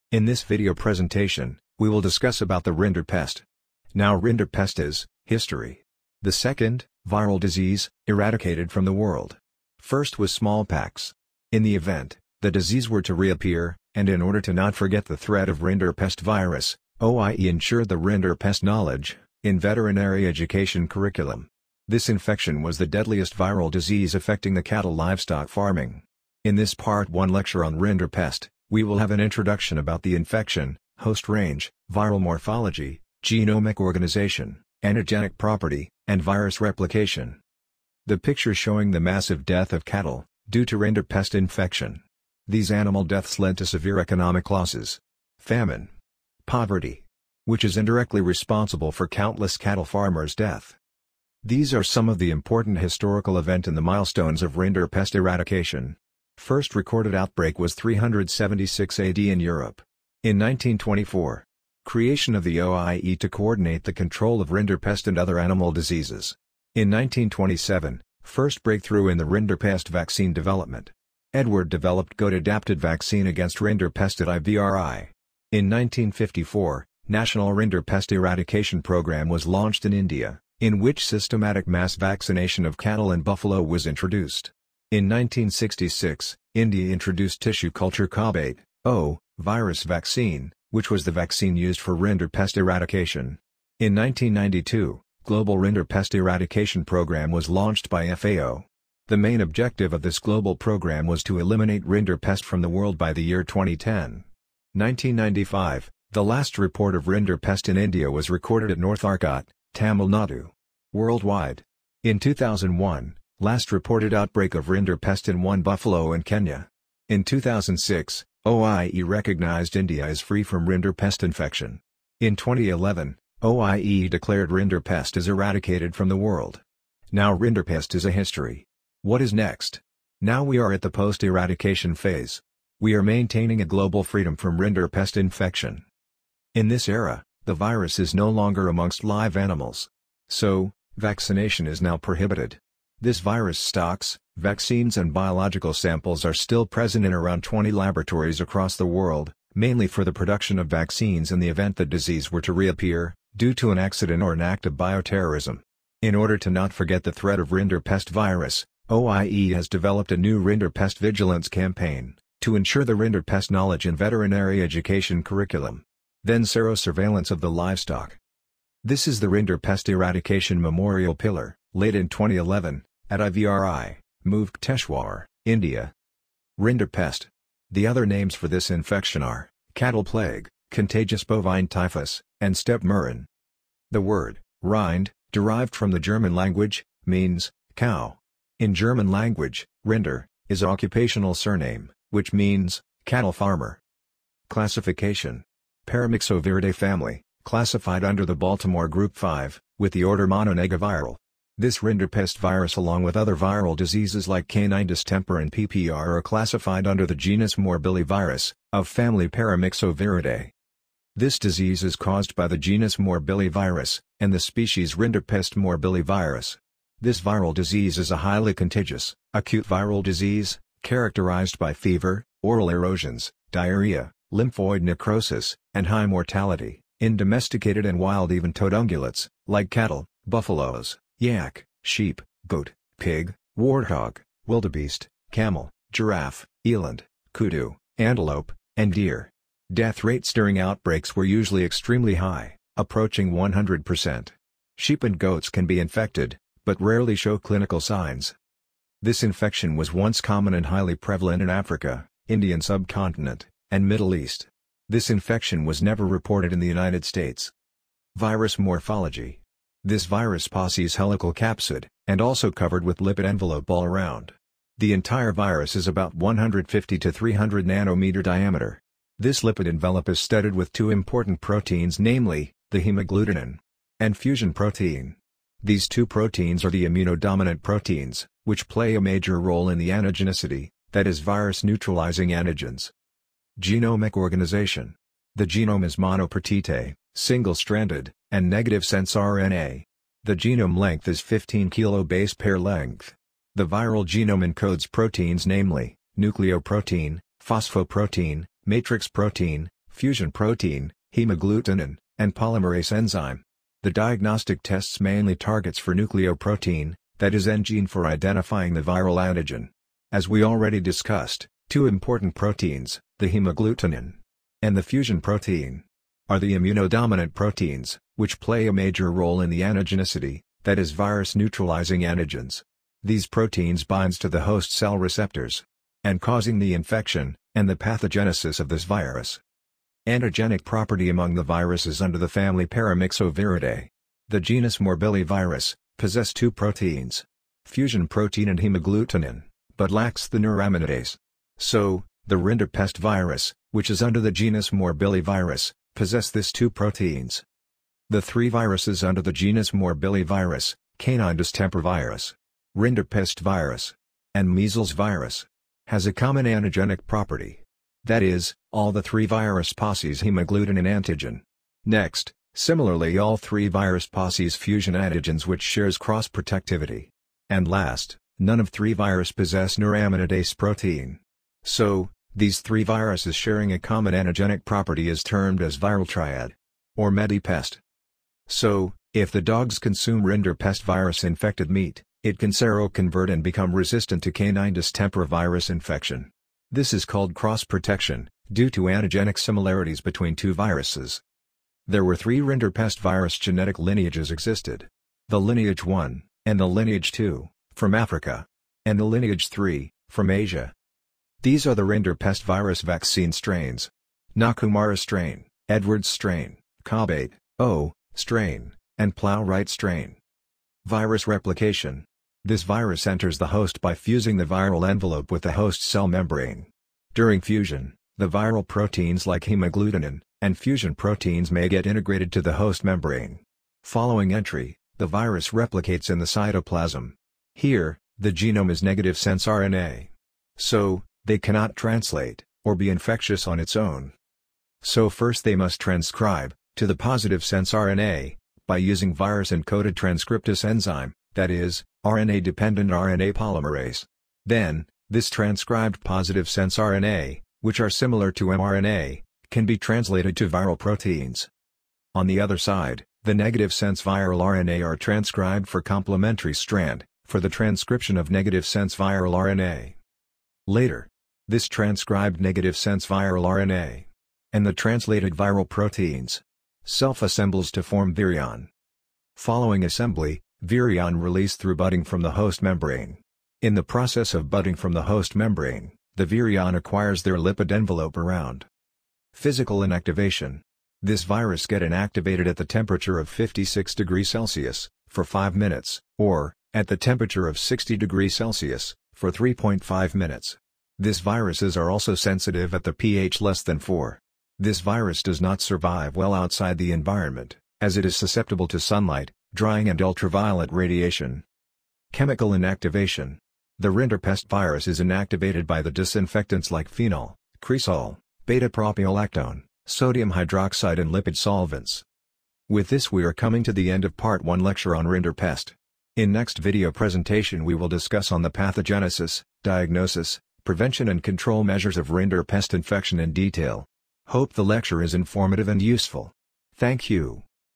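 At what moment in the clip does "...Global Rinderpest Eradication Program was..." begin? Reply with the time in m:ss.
1:35.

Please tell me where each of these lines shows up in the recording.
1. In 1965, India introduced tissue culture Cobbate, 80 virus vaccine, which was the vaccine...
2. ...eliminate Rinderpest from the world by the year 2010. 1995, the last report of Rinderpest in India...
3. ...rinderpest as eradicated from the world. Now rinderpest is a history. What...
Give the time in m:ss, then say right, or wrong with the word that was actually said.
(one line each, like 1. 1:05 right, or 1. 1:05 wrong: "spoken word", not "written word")
1. 1:24 wrong: "1966", not "1965"
2. 1:41 right
3. 2:04 right.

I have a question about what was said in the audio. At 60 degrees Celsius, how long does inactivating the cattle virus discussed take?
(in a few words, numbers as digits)
3.5 minutes.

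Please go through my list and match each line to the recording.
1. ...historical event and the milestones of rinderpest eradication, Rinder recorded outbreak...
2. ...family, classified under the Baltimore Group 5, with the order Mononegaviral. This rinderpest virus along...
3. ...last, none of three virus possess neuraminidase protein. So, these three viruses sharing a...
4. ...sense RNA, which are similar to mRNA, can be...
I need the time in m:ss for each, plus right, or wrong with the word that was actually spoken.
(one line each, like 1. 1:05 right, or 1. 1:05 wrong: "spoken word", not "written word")
1. 0:52 wrong: "First", not "Rinder"
2. 3:16 right
3. 6:07 right
4. 7:26 right.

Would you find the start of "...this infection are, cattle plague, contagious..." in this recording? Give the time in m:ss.
2:58.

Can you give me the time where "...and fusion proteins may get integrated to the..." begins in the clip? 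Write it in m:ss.
7:00.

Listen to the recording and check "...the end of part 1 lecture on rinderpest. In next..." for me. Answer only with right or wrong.
right.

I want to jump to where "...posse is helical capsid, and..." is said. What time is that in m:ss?
4:20.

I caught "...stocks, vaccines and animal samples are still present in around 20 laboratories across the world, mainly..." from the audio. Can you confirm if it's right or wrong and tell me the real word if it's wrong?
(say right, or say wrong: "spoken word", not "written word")
wrong: "biological", not "animal".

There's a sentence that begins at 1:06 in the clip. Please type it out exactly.
In 1927, first breakthrough in the rinderpest vaccine development.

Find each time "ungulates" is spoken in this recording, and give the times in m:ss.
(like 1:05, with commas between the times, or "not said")
3:48.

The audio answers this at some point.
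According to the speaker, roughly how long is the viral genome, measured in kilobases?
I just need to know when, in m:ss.
4:51.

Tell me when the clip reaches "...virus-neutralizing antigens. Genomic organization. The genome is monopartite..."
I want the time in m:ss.
4:41.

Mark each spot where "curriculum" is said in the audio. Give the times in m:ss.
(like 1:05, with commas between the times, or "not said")
0:20, 2:45.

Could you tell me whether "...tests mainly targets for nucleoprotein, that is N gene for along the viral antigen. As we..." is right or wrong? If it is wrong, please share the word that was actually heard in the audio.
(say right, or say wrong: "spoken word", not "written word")
wrong: "identifying", not "along".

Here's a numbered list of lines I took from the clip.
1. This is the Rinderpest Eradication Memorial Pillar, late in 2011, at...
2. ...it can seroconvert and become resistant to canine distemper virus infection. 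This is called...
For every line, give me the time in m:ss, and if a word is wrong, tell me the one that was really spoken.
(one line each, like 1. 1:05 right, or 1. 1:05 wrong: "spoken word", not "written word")
1. 2:48 right
2. 6:22 right.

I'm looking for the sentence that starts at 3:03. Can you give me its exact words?
The word, rind, derived from the German language, means, cow.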